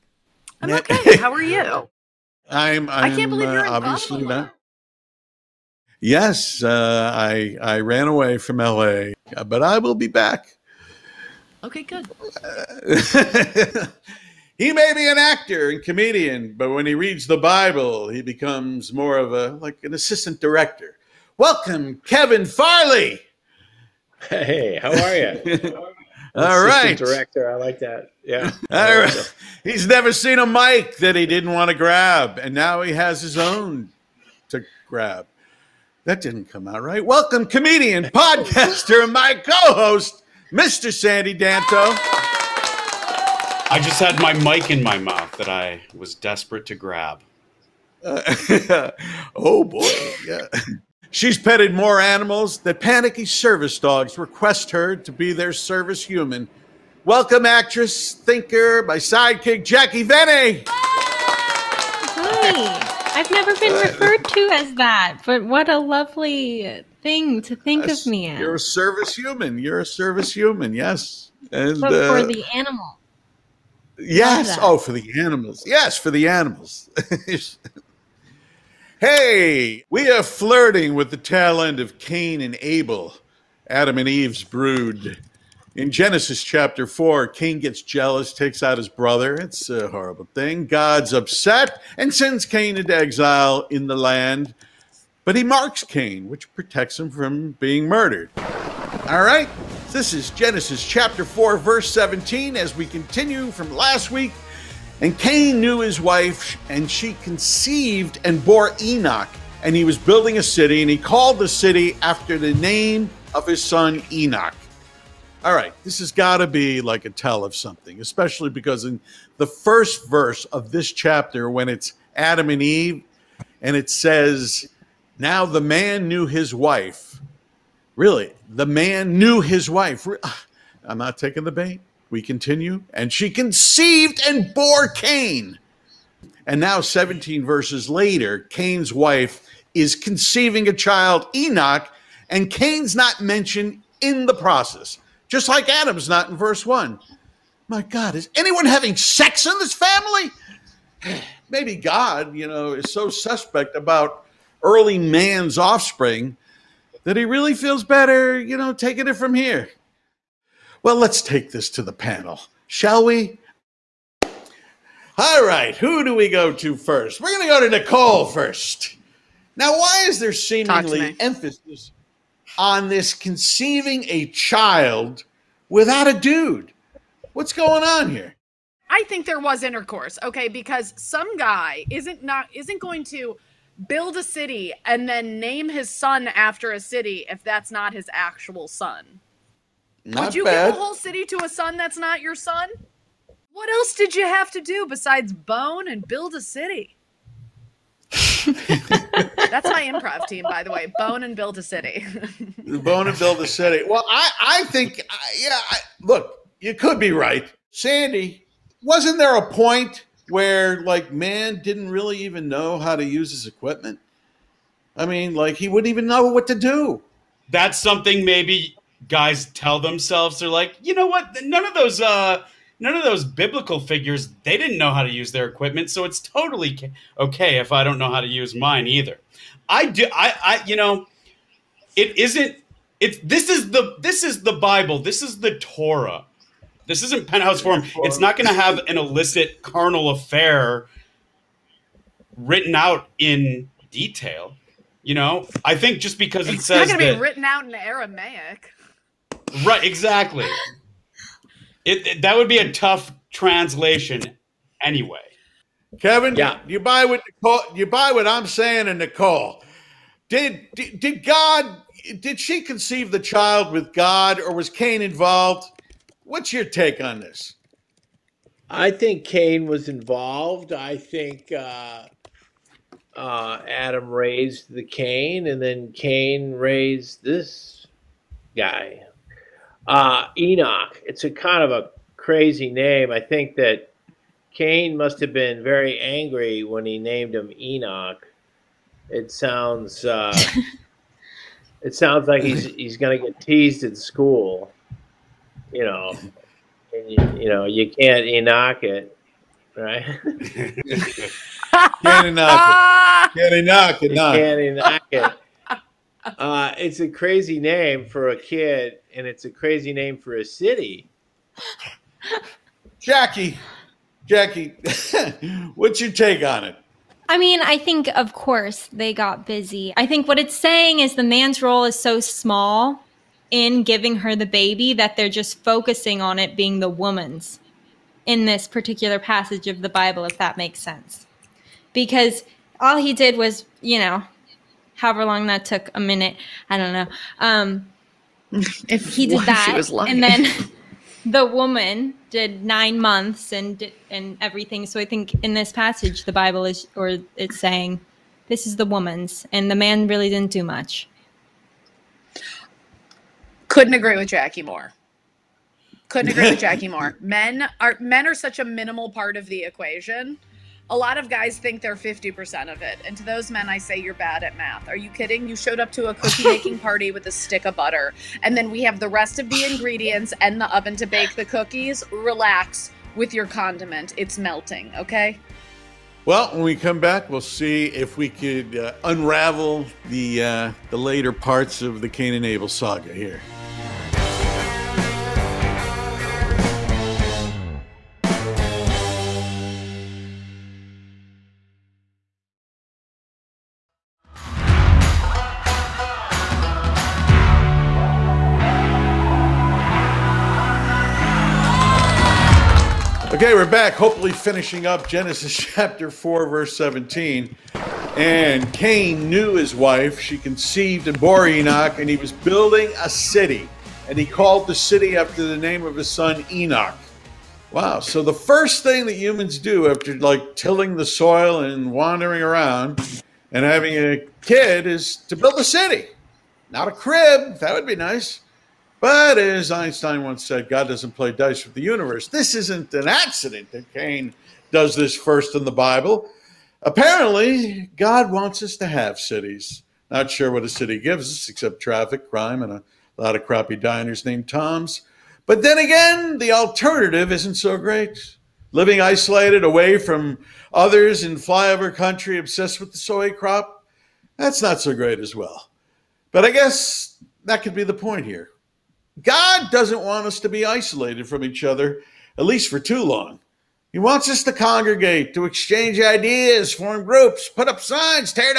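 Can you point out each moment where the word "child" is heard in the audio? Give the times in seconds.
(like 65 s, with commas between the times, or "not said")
140 s, 174 s, 263 s.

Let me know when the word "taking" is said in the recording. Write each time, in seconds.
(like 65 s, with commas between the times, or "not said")
131 s, 158 s.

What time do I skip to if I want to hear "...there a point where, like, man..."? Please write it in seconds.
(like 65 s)
209 s.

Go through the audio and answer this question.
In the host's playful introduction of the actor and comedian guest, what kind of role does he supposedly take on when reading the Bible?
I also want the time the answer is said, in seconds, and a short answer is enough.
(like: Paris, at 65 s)
assistant director, at 19 s.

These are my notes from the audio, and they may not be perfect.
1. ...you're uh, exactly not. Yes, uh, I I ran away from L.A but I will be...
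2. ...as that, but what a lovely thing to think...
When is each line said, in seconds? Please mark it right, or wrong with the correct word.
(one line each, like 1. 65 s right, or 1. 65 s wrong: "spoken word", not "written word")
1. 3 s wrong: "obviously", not "exactly"
2. 64 s right.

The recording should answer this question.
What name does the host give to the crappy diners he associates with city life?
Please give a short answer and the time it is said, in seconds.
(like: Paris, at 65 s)
Tom's, at 444 s.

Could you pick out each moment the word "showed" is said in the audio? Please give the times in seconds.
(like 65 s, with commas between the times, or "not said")
365 s.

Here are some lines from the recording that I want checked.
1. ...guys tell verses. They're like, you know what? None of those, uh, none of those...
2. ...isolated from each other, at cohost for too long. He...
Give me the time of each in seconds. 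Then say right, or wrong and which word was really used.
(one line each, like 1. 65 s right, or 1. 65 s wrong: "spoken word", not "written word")
1. 219 s wrong: "themselves", not "verses"
2. 460 s wrong: "least", not "cohost".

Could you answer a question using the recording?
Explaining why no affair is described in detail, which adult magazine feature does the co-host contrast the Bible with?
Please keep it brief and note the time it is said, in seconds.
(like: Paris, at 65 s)
Penthouse Forum, at 237 s.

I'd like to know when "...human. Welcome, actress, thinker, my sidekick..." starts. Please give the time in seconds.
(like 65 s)
56 s.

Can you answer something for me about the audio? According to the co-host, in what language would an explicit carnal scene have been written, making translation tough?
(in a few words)
Aramaic.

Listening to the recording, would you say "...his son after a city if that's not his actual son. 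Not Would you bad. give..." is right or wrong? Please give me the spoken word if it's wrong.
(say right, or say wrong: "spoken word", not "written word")
right.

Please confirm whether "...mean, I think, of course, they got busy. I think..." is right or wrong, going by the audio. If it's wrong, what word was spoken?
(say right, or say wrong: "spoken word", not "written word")
right.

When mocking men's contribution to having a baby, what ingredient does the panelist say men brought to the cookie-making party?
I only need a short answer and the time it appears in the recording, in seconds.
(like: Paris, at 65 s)
a stick of butter, at 367 s.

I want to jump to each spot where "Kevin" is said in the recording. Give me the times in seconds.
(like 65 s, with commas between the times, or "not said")
22 s, 255 s.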